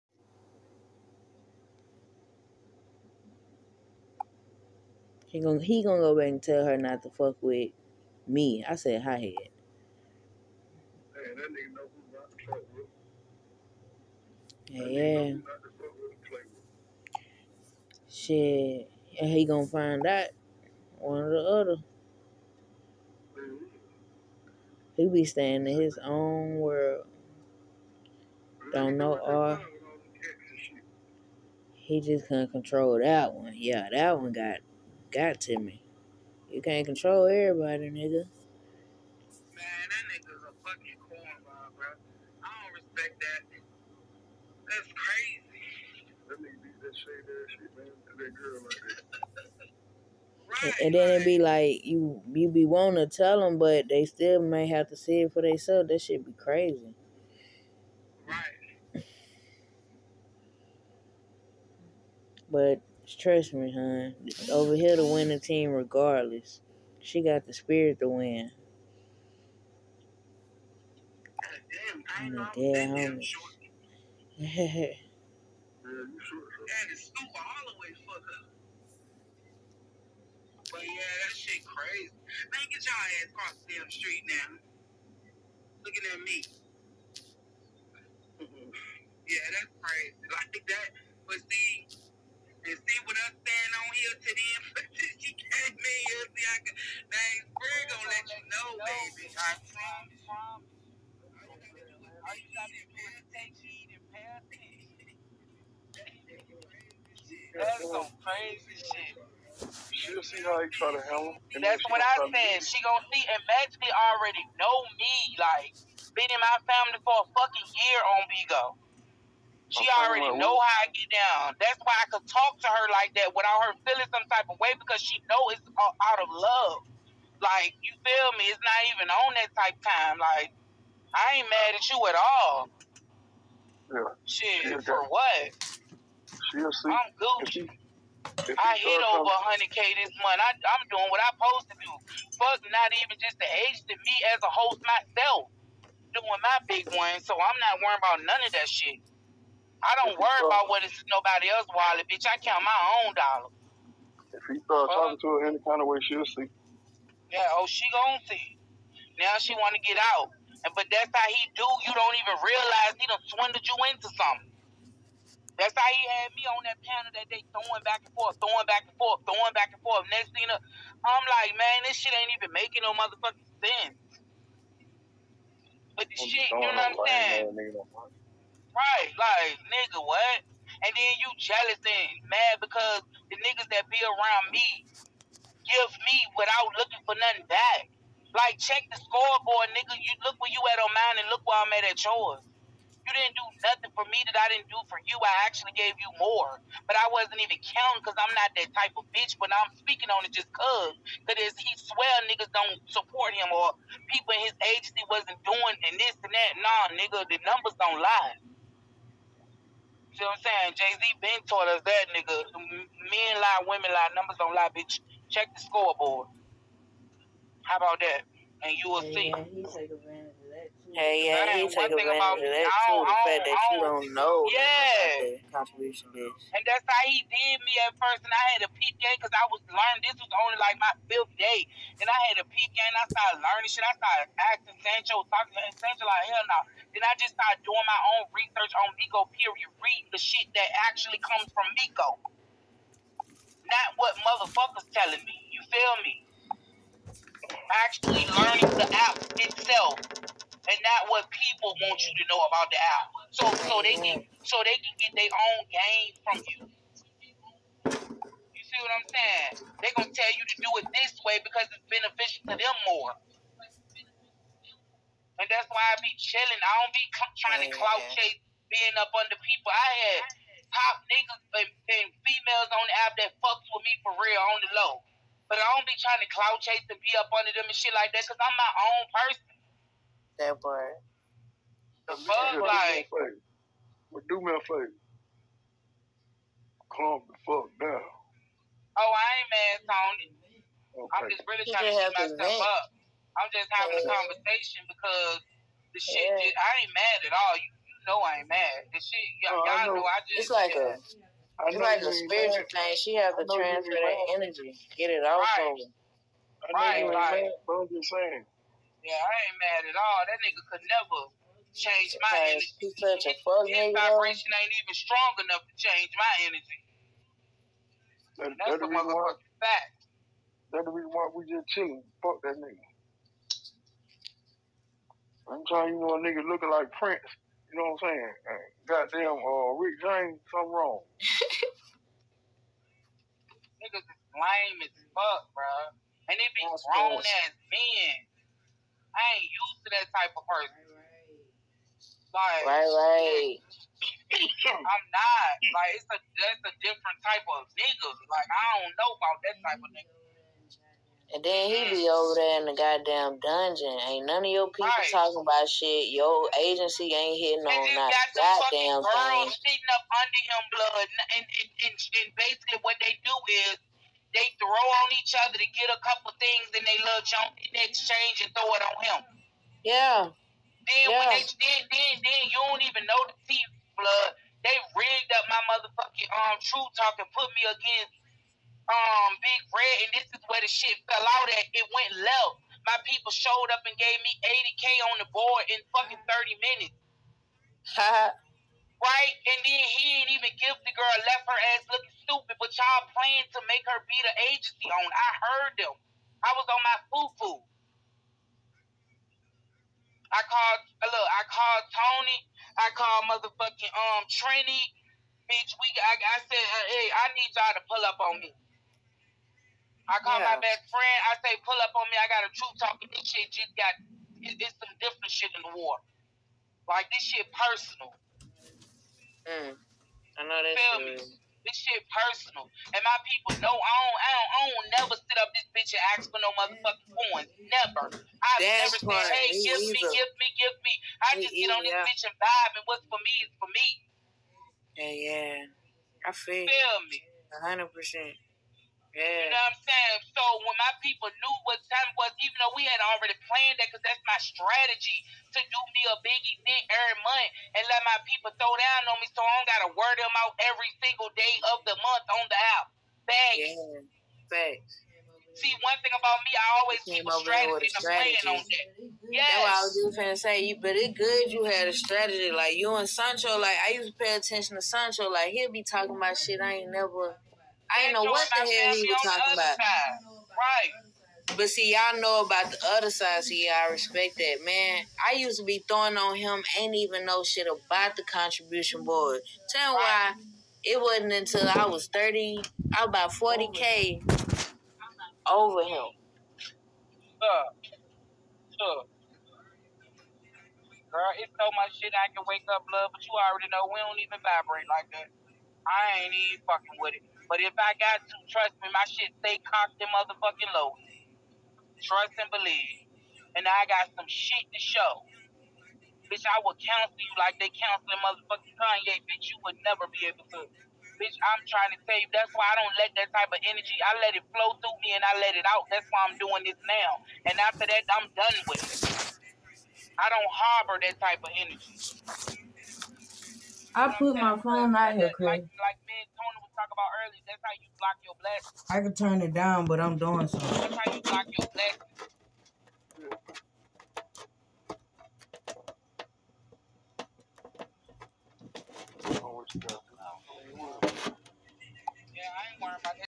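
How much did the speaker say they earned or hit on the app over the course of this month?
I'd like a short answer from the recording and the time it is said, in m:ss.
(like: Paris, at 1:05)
100k, at 2:19.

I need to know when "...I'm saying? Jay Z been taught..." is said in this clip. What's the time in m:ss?
3:30.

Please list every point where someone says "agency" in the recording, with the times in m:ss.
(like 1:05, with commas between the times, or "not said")
3:24, 5:56, 6:34.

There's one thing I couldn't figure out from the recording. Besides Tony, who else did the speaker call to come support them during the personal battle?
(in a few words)
Trini.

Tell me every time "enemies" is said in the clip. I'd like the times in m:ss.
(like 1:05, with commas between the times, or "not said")
not said.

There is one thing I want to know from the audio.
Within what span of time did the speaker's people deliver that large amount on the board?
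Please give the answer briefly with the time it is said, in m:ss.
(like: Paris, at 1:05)
30 minutes, at 6:26.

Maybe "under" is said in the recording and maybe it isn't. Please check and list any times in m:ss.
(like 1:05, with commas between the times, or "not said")
4:29, 4:37, 6:00.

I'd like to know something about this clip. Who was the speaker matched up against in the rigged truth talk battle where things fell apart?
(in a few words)
Big Red.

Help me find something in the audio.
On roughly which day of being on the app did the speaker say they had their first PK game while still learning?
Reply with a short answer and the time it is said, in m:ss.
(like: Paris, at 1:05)
fifth day, at 3:51.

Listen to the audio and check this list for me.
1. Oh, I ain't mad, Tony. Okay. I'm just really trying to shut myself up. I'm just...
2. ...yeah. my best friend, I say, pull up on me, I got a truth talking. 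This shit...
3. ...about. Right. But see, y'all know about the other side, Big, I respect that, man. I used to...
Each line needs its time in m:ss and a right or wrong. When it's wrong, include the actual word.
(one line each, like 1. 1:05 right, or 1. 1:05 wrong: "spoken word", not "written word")
1. 4:48 right
2. 6:50 right
3. 7:49 wrong: "See", not "Big".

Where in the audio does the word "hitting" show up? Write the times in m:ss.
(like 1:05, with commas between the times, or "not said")
5:57.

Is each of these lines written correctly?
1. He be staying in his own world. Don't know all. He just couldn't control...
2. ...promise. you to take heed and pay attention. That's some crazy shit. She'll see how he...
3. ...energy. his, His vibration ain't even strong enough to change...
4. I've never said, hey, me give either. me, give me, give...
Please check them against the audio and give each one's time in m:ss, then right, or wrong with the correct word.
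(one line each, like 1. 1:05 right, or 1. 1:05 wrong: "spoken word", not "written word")
1. 0:24 right
2. 1:39 right
3. 5:12 right
4. 7:08 right.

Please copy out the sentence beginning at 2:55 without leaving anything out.
But the shit, you know what I'm saying?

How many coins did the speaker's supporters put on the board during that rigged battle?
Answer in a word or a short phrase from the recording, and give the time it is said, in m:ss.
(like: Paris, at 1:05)
80k, at 6:24.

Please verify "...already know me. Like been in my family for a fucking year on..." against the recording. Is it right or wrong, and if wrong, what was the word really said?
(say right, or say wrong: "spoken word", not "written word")
right.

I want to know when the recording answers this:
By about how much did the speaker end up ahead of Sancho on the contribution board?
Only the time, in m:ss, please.
8:03.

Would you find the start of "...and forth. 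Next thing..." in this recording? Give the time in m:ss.
2:49.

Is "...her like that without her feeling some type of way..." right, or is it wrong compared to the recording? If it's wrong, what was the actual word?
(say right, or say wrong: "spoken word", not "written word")
right.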